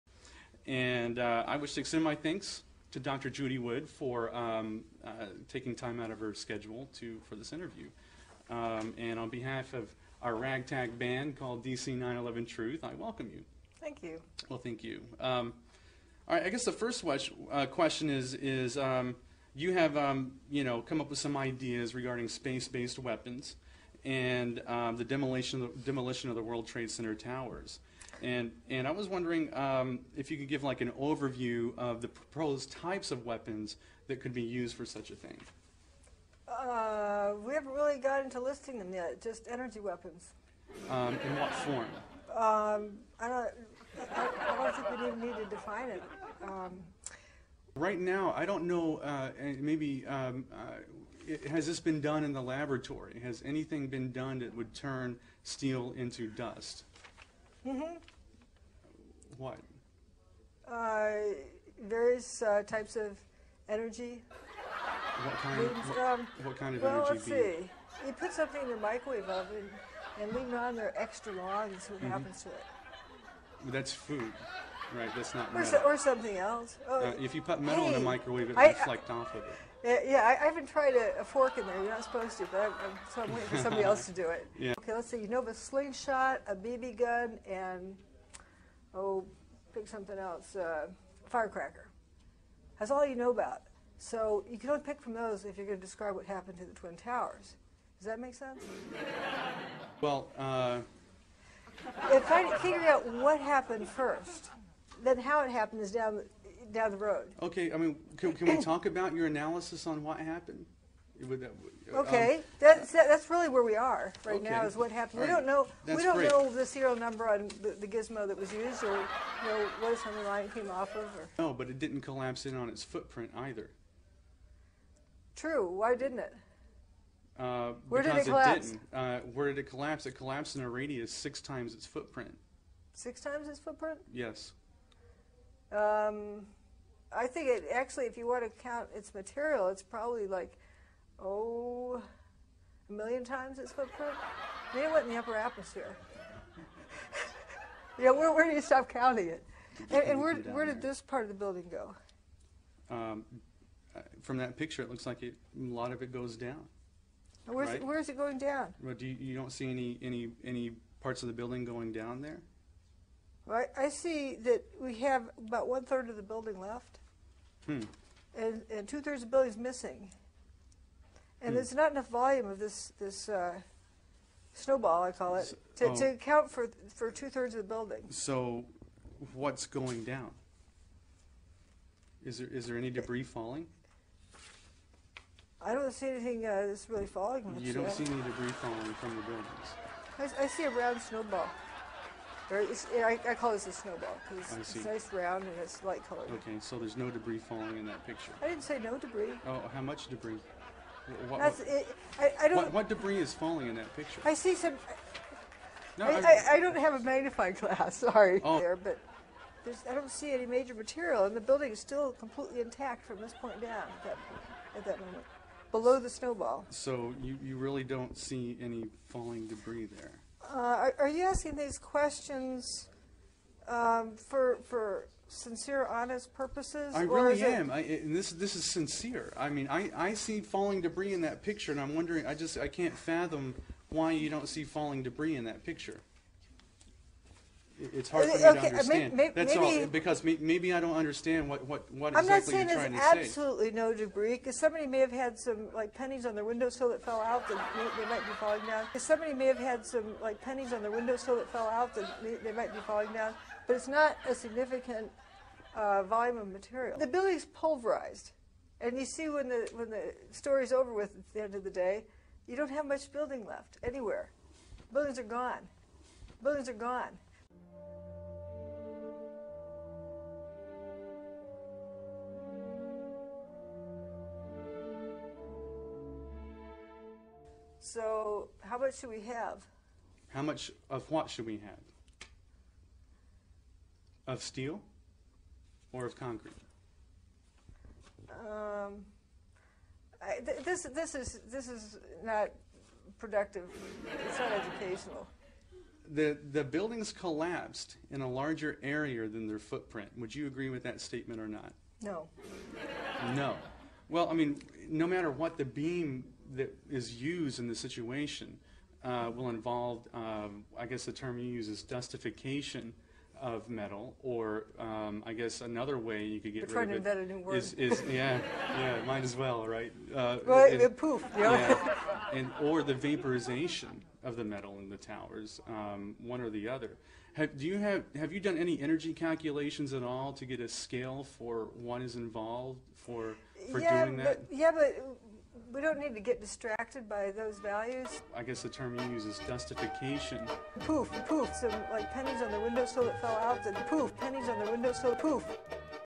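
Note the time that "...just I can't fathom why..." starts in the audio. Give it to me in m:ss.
3:52.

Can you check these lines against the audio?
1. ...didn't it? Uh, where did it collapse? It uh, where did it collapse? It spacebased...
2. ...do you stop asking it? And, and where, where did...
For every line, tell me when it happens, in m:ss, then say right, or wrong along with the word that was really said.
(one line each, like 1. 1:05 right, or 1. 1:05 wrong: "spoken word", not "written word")
1. 2:05 wrong: "collapsed", not "spacebased"
2. 2:28 wrong: "counting", not "asking".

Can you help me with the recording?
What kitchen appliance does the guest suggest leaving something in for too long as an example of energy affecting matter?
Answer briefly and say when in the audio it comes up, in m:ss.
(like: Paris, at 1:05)
Microwave oven, at 1:08.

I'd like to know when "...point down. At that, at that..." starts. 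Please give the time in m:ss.
3:33.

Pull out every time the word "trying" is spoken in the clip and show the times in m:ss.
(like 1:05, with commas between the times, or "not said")
4:02, 5:17.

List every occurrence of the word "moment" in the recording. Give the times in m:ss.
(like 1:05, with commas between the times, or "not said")
3:34.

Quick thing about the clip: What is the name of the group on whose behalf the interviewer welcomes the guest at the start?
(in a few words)
DC 911 Truth.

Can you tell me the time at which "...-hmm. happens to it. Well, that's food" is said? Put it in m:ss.
1:12.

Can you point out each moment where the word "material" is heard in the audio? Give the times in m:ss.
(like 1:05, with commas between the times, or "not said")
2:19, 3:30, 4:16.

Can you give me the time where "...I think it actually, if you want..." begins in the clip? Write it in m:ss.
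2:17.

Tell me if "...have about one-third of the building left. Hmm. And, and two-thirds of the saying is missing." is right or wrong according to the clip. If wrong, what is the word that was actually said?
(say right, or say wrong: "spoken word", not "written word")
wrong: "building", not "saying".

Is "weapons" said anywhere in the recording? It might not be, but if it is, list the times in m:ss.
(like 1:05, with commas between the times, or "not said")
0:22, 0:33, 0:39.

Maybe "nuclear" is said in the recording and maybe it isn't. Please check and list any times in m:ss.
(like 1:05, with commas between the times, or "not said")
not said.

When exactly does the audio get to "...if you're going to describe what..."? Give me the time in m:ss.
1:35.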